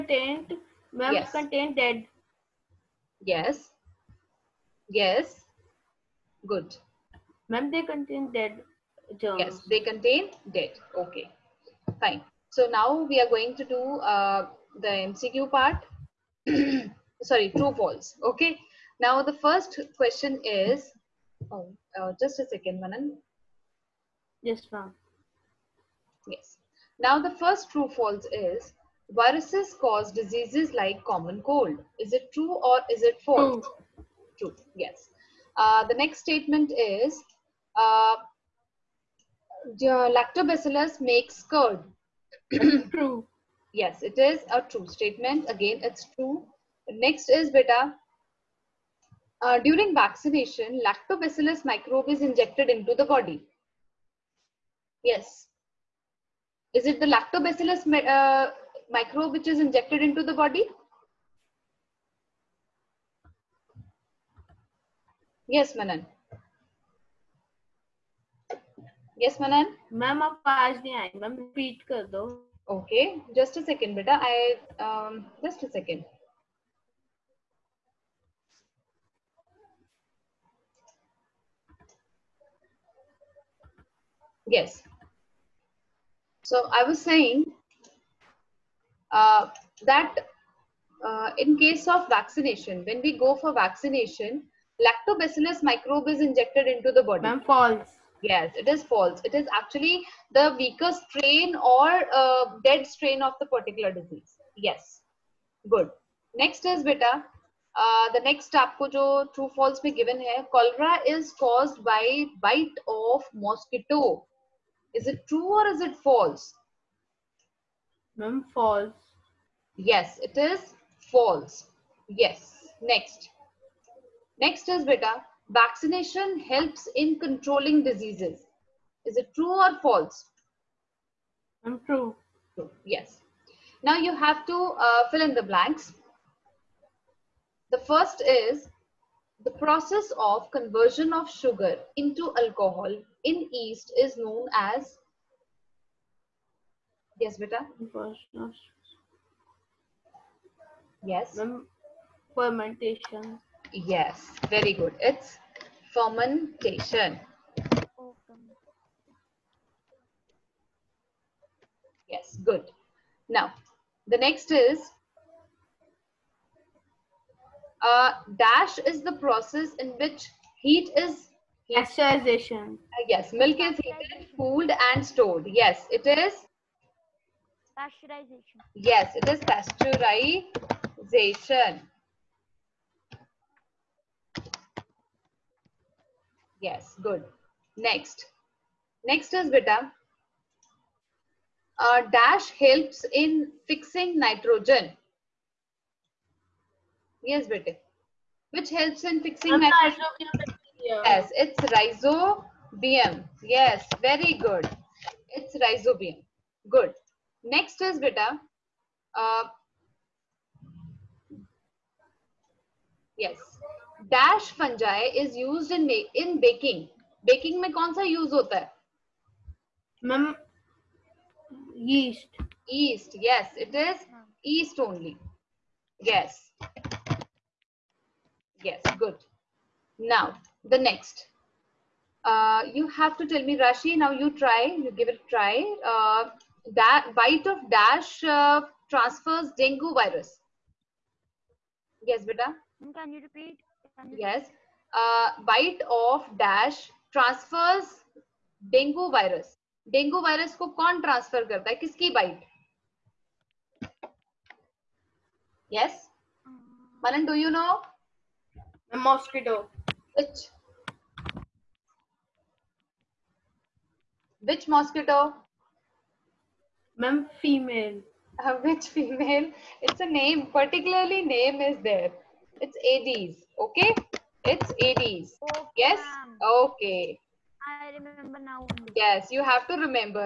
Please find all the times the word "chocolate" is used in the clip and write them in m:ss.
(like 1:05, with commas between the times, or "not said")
not said.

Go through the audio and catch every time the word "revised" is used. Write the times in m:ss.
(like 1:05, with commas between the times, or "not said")
not said.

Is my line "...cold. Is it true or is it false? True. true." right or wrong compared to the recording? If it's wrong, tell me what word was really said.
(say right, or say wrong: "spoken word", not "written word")
right.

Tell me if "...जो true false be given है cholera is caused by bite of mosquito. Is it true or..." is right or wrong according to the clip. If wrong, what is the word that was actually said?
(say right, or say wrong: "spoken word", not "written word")
right.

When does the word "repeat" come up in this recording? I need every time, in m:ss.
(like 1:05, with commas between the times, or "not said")
1:11, 4:03.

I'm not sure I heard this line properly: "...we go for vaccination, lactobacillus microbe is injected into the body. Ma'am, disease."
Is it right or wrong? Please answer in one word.
wrong.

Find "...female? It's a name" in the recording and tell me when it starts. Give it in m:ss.
4:28.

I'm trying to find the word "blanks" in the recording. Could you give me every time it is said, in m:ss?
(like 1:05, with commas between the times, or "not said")
2:15.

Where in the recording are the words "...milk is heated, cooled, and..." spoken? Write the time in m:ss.
2:53.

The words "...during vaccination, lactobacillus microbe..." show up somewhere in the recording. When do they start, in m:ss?
0:49.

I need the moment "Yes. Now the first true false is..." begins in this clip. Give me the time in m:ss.
0:26.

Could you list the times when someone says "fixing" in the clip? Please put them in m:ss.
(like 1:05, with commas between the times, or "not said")
3:13, 3:19.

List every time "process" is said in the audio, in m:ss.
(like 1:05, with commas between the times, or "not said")
2:19, 2:49.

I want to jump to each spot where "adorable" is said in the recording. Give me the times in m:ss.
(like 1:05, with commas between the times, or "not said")
not said.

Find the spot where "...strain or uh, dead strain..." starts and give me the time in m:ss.
1:40.